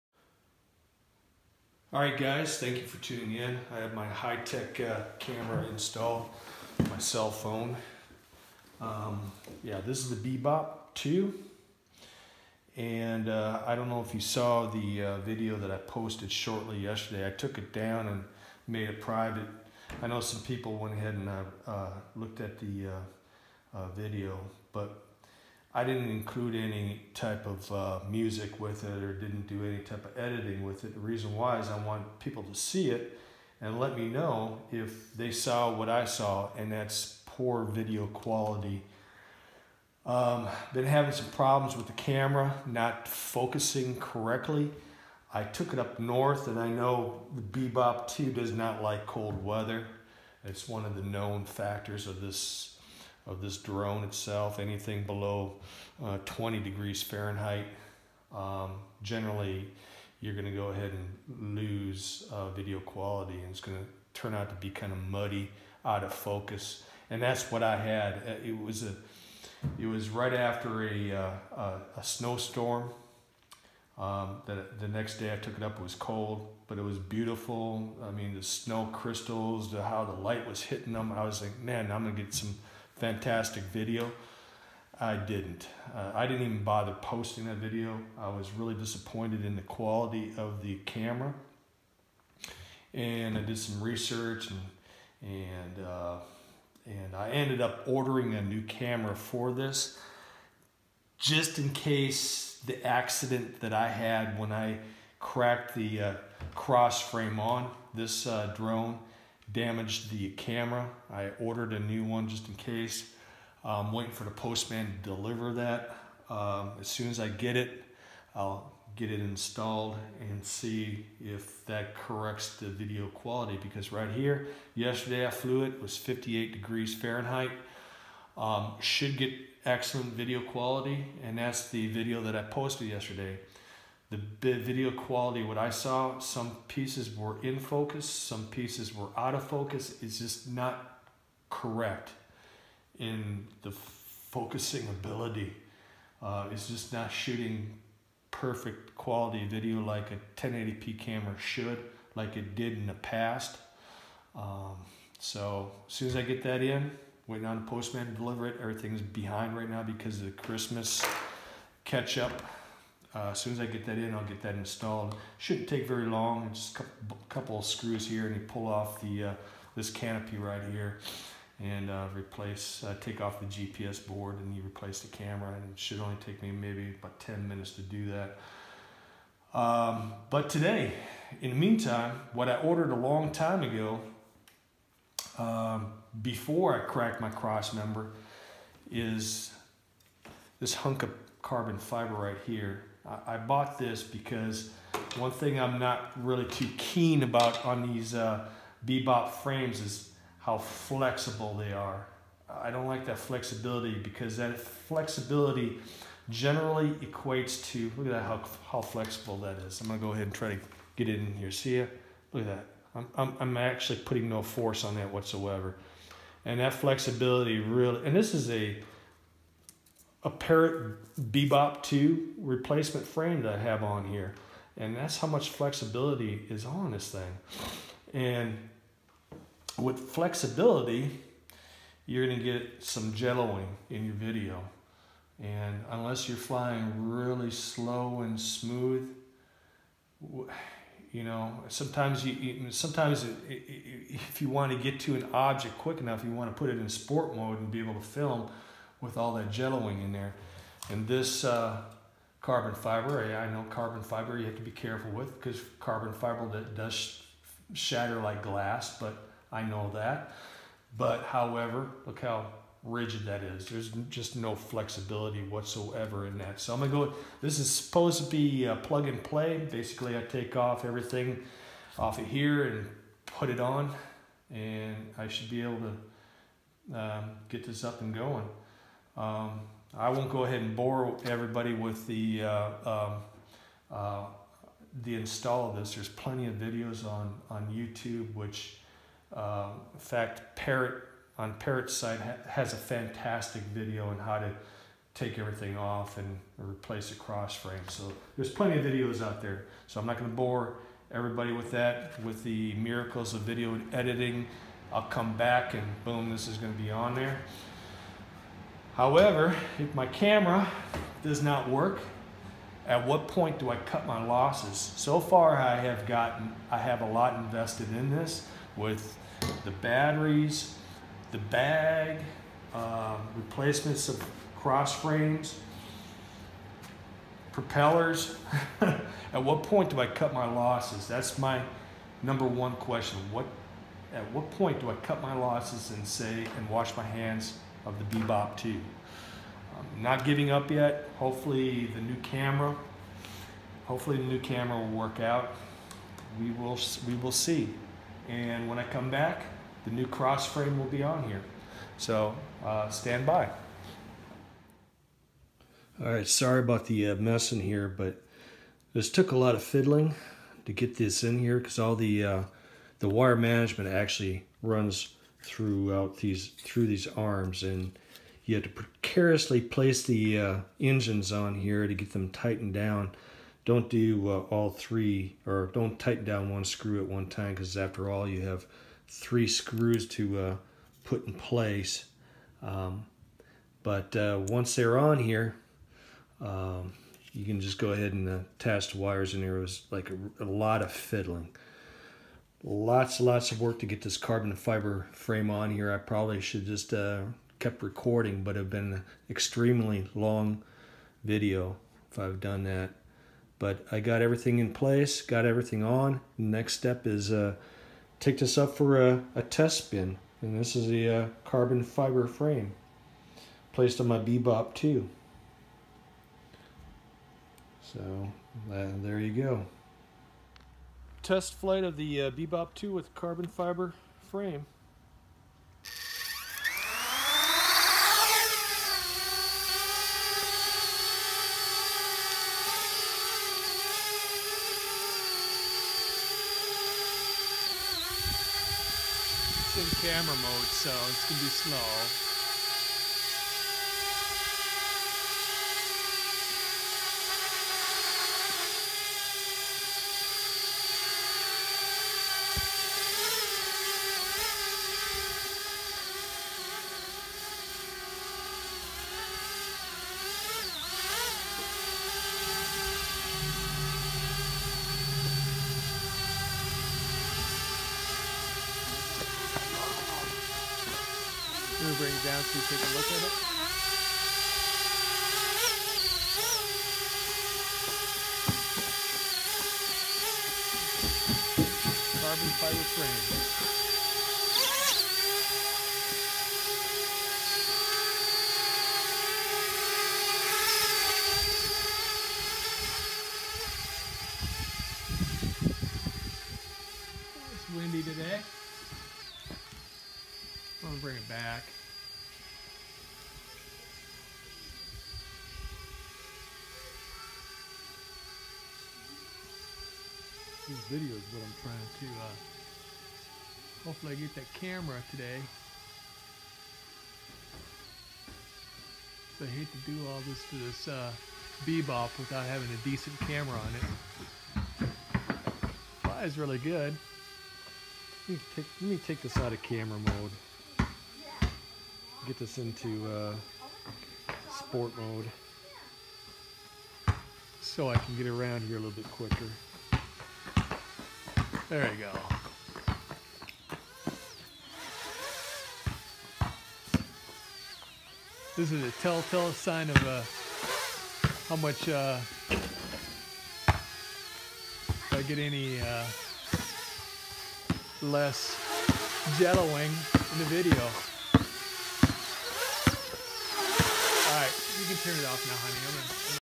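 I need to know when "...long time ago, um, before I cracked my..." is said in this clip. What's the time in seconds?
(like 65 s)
182 s.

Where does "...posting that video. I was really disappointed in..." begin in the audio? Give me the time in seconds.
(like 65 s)
87 s.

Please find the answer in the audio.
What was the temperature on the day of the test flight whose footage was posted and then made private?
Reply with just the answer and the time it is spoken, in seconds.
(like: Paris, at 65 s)
58 degrees Fahrenheit, at 125 s.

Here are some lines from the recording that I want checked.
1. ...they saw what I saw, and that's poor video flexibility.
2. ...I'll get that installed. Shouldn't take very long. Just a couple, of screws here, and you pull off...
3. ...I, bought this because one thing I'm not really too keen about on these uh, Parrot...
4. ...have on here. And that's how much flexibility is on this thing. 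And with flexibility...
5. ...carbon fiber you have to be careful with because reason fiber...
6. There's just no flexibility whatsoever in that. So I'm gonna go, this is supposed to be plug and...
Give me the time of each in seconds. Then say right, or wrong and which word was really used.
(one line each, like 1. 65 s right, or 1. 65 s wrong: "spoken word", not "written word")
1. 35 s wrong: "quality", not "flexibility"
2. 164 s right
3. 193 s wrong: "Bebop", not "Parrot"
4. 223 s right
5. 253 s wrong: "carbon", not "reason"
6. 263 s right.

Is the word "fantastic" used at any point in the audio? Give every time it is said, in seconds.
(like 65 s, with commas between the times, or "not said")
83 s, 292 s.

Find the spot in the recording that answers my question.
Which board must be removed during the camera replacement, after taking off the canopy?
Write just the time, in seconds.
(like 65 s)
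173 s.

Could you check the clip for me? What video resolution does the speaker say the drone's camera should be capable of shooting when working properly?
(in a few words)
1080p.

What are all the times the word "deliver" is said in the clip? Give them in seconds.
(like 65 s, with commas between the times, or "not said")
115 s, 158 s.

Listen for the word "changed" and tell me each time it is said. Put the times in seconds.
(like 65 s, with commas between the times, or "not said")
not said.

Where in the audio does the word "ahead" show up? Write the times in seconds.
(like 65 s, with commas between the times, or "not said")
20 s, 60 s, 210 s, 280 s, 387 s.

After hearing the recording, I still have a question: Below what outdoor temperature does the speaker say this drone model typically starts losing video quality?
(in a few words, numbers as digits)
20 degrees Fahrenheit.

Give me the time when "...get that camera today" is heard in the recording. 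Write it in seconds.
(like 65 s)
514 s.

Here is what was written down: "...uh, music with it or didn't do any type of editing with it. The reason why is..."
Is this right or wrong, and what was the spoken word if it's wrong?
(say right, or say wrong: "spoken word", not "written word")
right.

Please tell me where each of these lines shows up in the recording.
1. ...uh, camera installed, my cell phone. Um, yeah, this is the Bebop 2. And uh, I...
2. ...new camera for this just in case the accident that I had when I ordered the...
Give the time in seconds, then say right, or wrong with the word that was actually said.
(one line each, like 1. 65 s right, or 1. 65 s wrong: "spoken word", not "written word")
1. 4 s right
2. 98 s wrong: "cracked", not "ordered".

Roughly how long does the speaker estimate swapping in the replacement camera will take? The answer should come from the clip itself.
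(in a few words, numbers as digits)
10 minutes.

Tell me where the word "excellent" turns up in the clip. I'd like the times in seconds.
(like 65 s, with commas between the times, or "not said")
129 s.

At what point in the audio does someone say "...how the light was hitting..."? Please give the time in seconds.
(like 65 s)
79 s.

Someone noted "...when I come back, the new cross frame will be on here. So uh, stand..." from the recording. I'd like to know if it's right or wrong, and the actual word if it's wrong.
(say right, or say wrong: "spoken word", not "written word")
right.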